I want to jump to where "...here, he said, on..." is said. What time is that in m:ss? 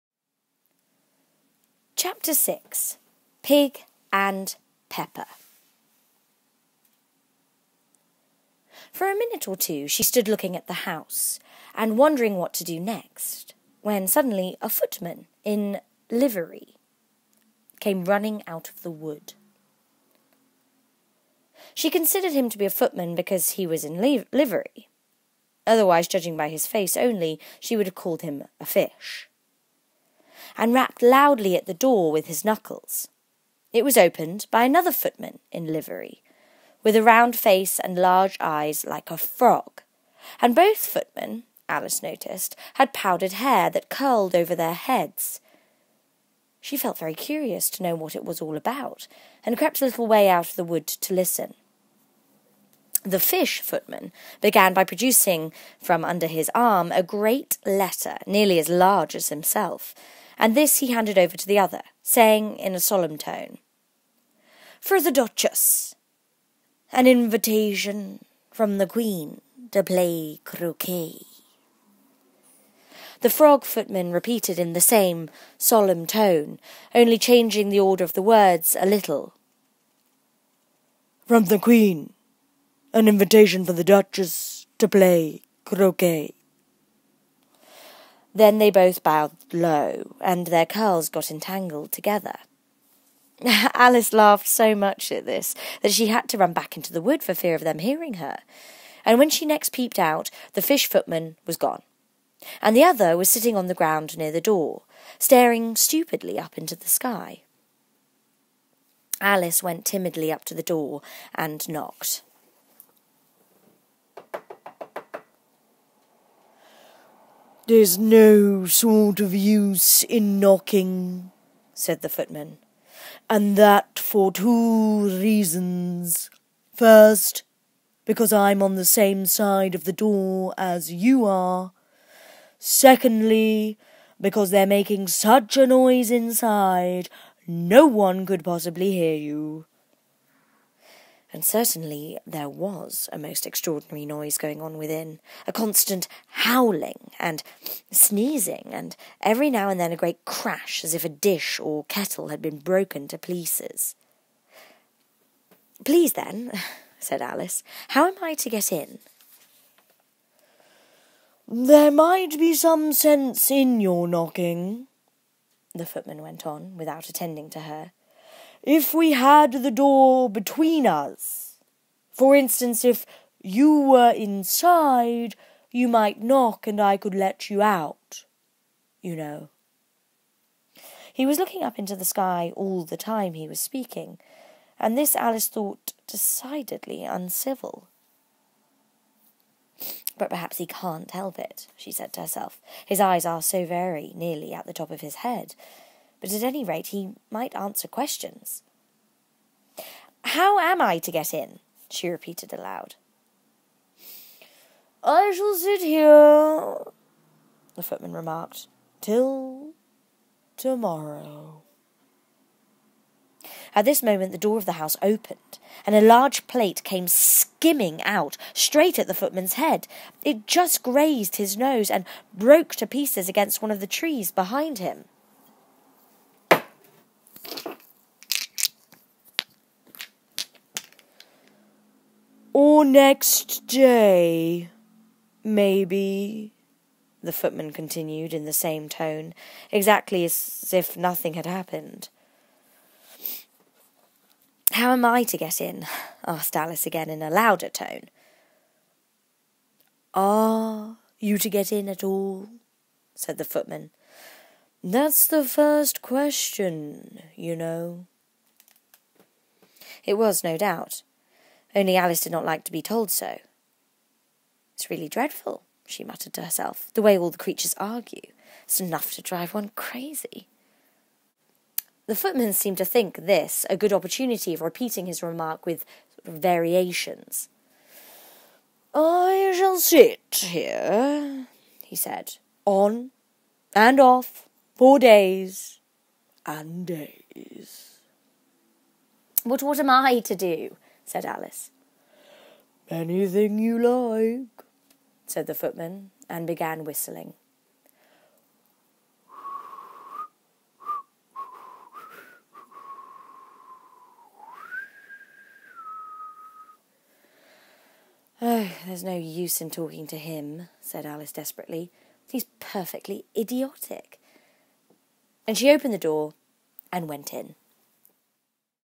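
4:40.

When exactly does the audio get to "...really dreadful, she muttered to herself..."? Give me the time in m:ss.
4:24.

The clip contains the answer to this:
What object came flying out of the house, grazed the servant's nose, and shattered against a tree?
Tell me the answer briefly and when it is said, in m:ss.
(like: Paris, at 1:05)
a large plate, at 3:36.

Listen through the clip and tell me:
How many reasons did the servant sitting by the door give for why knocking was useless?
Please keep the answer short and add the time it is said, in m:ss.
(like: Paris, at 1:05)
2, at 2:04.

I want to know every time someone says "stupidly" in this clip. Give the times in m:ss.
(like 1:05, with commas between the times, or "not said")
1:45.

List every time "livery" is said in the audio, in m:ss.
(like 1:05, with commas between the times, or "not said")
0:16, 0:24, 0:35.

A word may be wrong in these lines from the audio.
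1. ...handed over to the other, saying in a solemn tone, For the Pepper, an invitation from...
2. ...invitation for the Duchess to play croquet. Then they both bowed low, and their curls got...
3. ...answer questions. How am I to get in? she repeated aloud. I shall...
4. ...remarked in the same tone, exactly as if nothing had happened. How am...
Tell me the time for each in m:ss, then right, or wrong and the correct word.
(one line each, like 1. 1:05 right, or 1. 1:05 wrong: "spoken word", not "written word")
1. 1:00 wrong: "Duchess", not "Pepper"
2. 1:23 right
3. 3:17 right
4. 3:57 wrong: "continued", not "remarked".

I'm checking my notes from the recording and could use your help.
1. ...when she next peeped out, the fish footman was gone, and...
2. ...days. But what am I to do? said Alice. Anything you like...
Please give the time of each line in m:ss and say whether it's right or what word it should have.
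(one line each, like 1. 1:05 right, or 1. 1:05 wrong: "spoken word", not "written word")
1. 1:39 right
2. 4:46 right.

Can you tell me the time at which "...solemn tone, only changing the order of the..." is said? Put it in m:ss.
1:15.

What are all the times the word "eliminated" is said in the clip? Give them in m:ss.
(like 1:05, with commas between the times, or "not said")
not said.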